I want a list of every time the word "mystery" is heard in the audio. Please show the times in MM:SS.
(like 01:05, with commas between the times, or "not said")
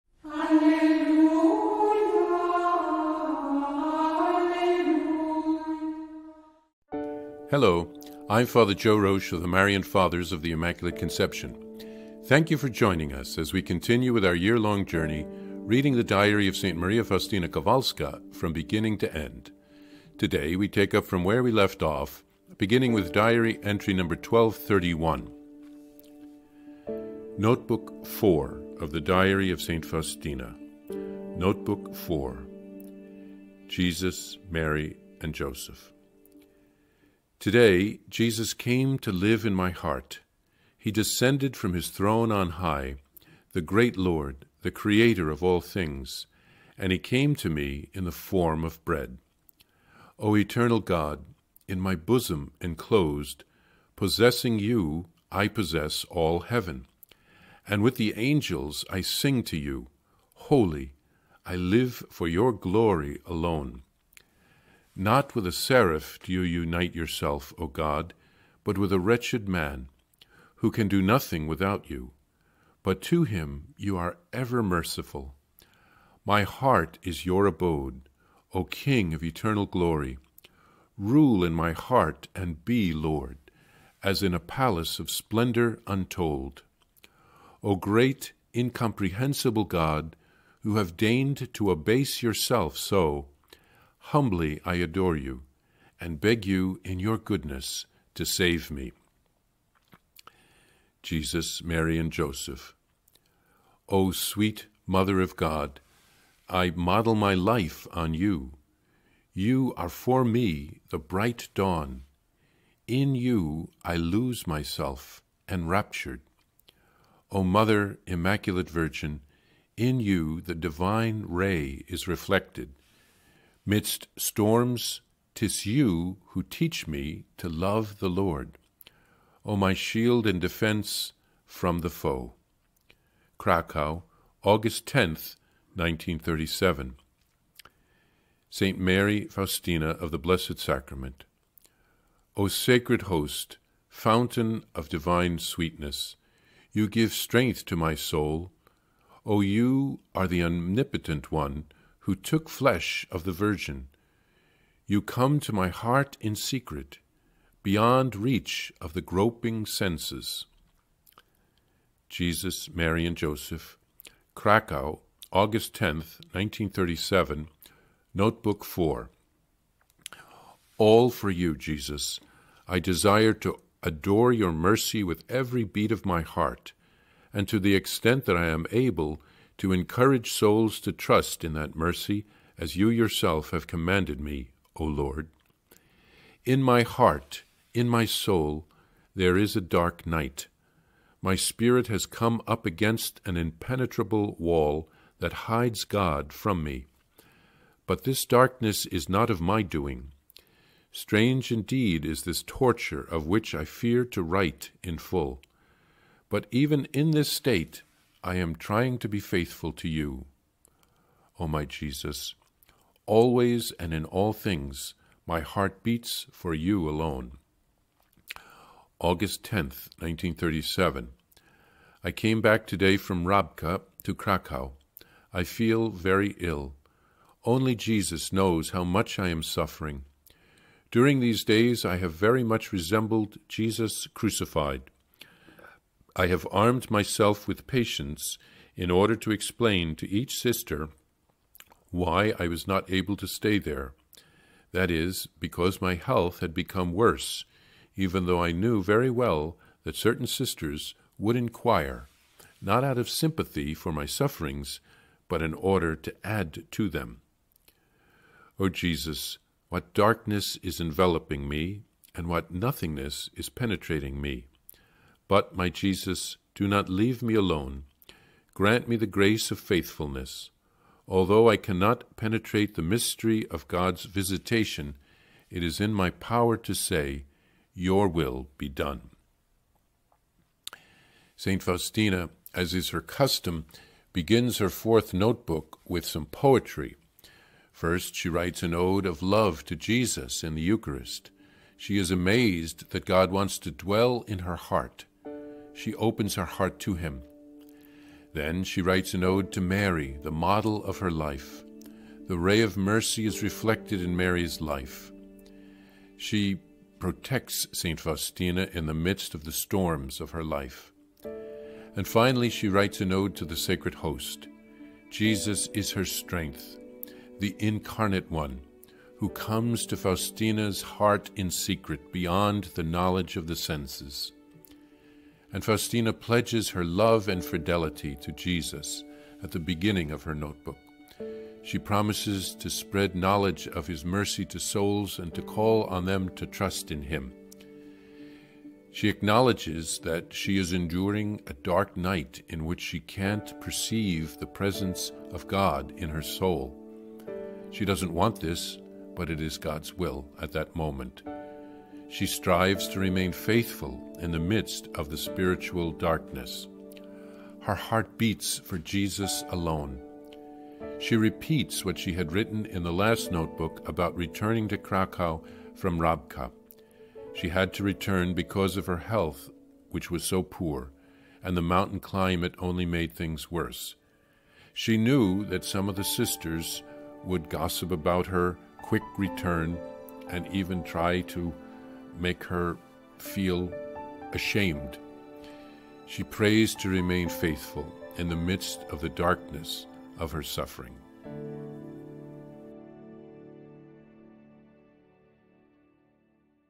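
04:32.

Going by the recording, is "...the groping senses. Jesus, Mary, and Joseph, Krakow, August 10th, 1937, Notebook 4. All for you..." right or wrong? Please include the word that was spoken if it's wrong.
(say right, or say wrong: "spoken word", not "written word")
right.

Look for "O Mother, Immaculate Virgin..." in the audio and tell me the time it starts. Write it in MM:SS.
01:57.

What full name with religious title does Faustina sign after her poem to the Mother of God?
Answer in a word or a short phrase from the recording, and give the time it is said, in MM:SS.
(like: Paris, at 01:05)
St. Mary Faustina of the Blessed Sacrament, at 02:18.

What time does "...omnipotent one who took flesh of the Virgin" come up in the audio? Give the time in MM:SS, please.
02:30.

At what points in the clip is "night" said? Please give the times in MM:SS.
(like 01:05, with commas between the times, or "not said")
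03:10, 05:41.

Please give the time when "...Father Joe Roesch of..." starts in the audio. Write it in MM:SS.
00:08.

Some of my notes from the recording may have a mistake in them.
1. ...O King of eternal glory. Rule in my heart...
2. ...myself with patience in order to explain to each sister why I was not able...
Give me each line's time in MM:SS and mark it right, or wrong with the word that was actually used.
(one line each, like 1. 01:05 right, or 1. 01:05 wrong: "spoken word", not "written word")
1. 01:18 right
2. 03:56 right.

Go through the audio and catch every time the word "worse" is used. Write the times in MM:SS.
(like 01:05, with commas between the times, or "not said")
04:06, 06:13.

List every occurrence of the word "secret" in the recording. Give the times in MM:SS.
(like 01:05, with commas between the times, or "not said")
02:36, 05:21.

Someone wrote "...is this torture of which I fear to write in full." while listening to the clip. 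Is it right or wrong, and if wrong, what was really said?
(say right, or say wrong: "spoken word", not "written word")
right.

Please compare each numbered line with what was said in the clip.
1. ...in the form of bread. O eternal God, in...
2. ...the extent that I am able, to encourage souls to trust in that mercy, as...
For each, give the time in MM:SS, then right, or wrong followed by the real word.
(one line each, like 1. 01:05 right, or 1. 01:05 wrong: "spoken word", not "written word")
1. 00:47 right
2. 02:57 right.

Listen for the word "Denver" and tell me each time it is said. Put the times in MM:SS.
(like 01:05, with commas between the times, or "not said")
not said.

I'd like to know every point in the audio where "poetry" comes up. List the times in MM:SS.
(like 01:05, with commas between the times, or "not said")
04:46.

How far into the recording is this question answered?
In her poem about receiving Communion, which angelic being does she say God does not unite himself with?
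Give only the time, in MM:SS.
01:05.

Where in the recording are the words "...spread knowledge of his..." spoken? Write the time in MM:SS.
05:32.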